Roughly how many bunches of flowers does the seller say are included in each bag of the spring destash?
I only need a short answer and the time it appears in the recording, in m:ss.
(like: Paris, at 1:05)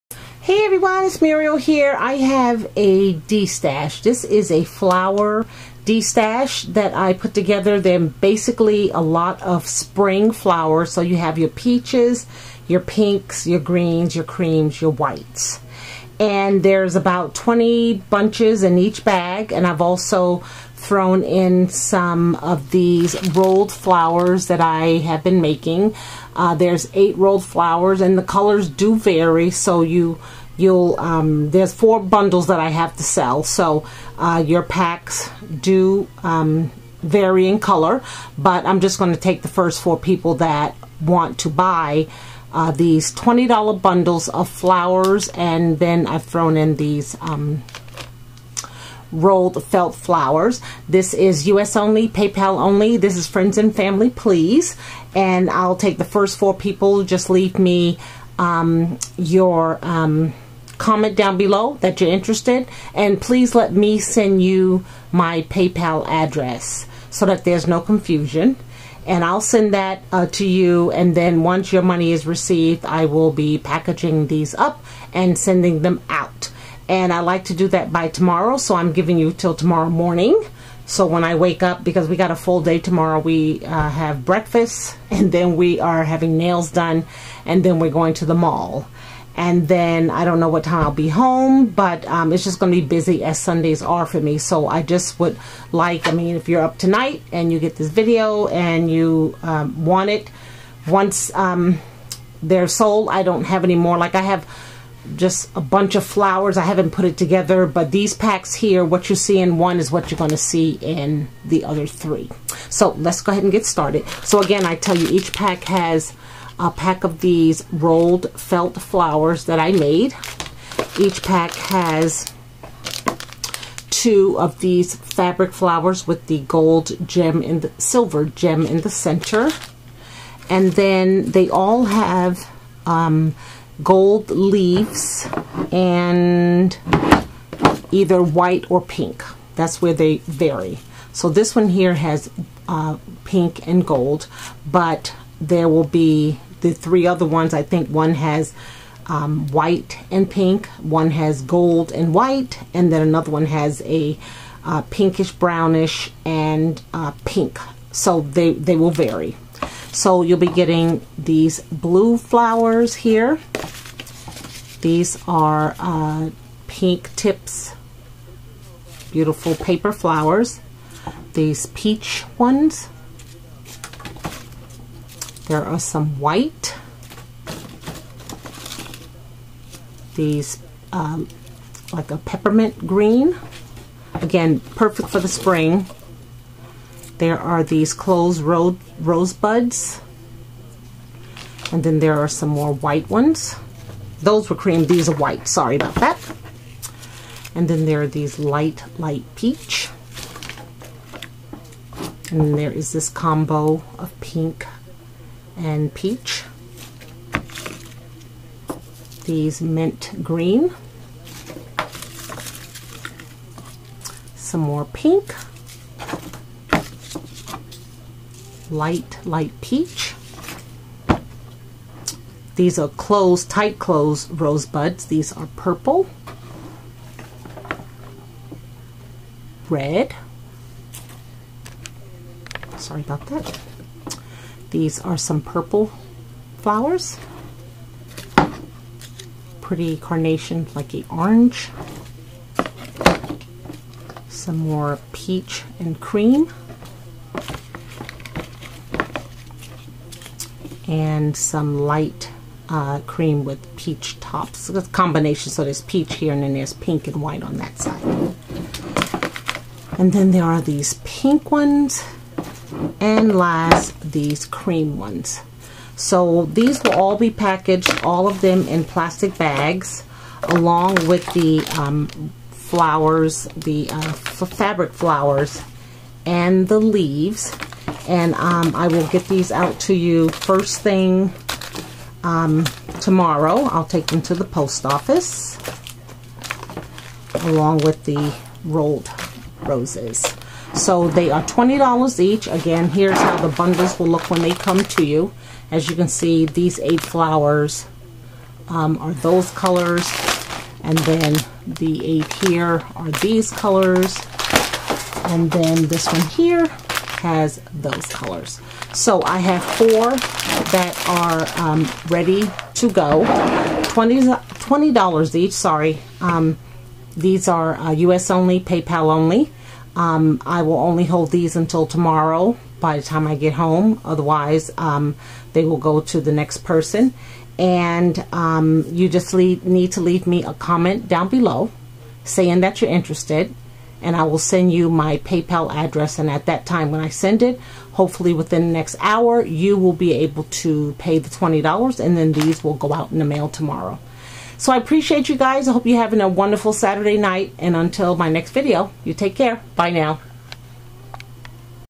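20, at 0:16.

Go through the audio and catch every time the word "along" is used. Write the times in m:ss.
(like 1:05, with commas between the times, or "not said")
4:30, 4:47.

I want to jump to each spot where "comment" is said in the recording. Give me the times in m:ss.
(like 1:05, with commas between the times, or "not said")
1:00, 5:30.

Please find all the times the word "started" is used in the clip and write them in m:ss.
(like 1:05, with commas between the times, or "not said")
1:53.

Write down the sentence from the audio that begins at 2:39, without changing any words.
So you'll be getting these blue flowers here.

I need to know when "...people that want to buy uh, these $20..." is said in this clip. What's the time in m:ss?
0:39.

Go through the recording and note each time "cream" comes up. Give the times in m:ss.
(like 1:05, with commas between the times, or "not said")
0:14, 3:14, 4:05, 4:12, 4:24.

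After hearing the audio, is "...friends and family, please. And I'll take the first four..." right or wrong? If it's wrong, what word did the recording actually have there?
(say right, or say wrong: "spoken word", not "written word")
right.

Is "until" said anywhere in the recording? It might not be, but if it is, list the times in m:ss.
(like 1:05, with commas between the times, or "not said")
5:21, 5:47.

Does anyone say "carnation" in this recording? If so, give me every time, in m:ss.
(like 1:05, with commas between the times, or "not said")
3:59.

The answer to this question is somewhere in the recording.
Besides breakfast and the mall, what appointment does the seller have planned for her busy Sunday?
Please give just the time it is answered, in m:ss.
1:26.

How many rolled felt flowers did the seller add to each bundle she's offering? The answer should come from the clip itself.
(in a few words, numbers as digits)
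8.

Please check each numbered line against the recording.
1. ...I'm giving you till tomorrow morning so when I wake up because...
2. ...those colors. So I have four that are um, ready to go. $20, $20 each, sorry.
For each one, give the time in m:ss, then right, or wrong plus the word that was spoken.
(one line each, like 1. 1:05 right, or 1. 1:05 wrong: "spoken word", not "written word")
1. 1:18 right
2. 5:07 right.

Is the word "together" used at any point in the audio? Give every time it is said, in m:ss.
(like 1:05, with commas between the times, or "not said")
0:07, 1:47.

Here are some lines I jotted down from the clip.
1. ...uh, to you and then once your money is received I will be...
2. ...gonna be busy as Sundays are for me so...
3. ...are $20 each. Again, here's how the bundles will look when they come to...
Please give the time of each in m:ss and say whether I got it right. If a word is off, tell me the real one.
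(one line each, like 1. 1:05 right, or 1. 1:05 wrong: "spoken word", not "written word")
1. 1:10 right
2. 1:32 right
3. 4:51 right.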